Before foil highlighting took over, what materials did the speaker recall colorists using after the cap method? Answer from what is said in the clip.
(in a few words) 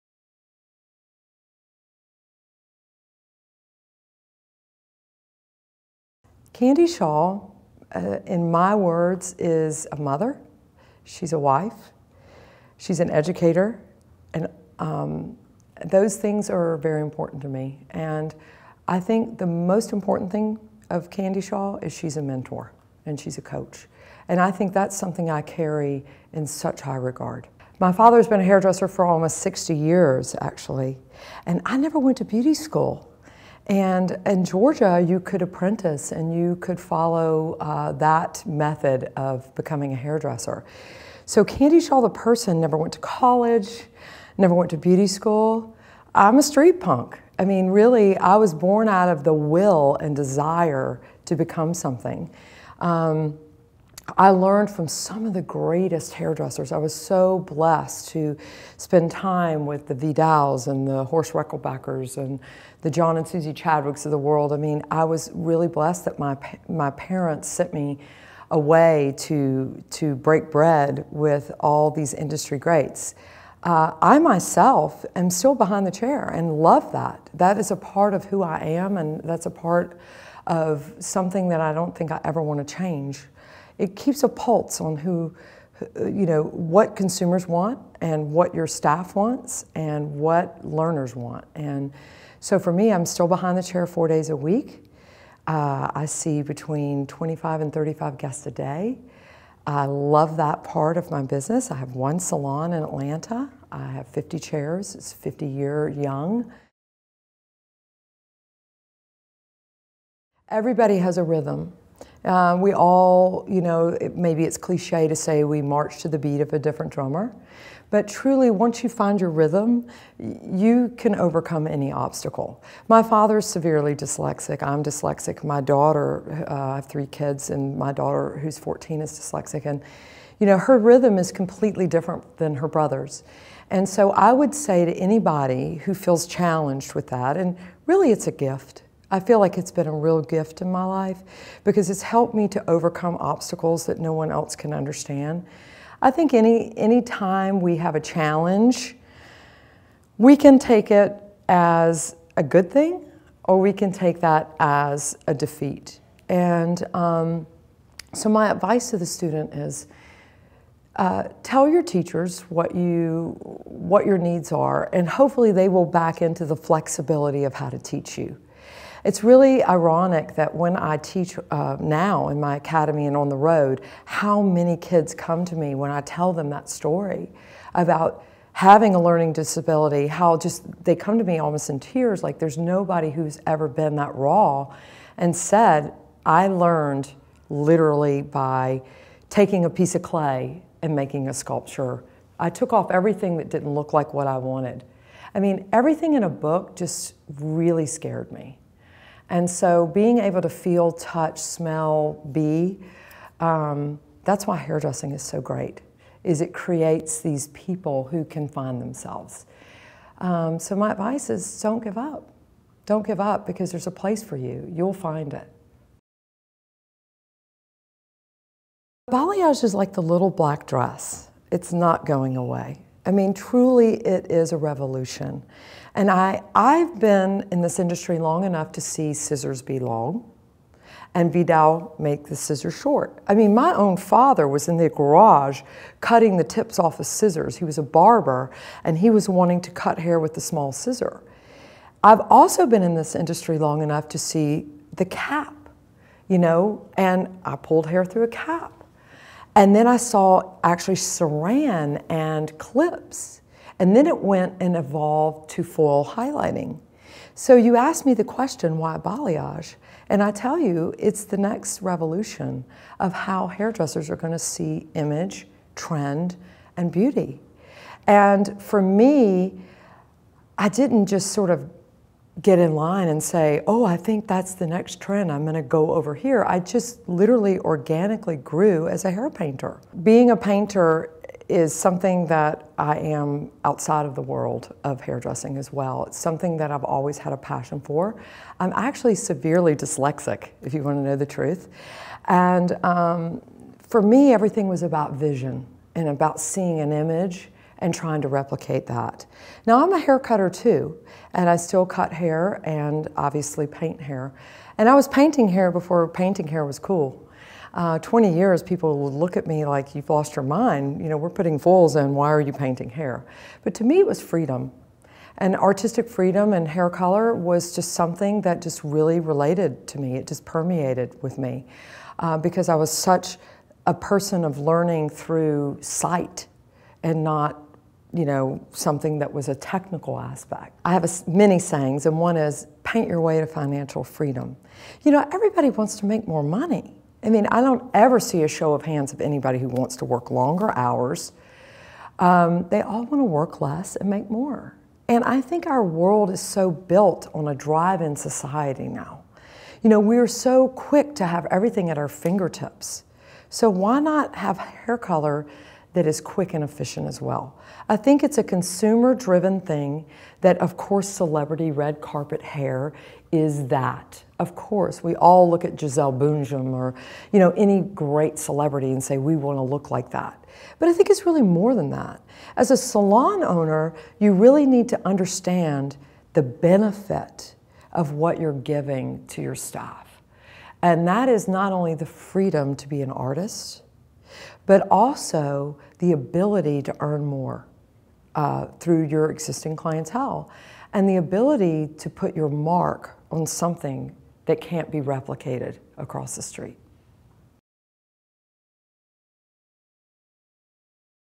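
saran and clips.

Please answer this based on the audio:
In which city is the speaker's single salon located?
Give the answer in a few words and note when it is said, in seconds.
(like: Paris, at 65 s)
Atlanta, at 102 s.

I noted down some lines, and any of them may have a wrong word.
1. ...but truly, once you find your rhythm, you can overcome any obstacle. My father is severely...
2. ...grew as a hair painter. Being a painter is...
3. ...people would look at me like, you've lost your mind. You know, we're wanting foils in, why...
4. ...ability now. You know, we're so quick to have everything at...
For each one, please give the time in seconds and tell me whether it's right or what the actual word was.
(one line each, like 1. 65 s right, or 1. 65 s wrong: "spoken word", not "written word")
1. 117 s right
2. 278 s right
3. 308 s wrong: "putting", not "wanting"
4. 348 s wrong: "society", not "ability".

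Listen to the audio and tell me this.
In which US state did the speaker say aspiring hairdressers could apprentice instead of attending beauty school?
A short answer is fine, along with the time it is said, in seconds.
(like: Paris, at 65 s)
Georgia, at 34 s.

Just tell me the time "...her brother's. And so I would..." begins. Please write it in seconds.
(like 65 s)
132 s.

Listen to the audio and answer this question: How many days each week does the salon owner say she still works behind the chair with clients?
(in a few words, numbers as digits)
4.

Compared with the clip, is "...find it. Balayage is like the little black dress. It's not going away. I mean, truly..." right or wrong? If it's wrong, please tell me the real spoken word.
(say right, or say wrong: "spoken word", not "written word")
right.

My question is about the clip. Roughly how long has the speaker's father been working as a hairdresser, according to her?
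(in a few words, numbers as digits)
almost 60 years.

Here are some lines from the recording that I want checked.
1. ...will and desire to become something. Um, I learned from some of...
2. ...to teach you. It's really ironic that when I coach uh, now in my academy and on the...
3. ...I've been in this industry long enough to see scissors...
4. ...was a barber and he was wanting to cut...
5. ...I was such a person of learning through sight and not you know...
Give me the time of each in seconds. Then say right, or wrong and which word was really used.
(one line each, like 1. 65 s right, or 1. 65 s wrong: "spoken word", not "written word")
1. 49 s right
2. 167 s wrong: "teach", not "coach"
3. 226 s right
4. 237 s right
5. 322 s right.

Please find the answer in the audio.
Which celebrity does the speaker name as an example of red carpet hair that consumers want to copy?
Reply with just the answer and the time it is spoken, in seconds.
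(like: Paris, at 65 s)
Gisele Bündchen, at 365 s.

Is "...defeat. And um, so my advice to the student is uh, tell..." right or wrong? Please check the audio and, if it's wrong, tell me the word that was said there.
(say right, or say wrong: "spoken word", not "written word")
right.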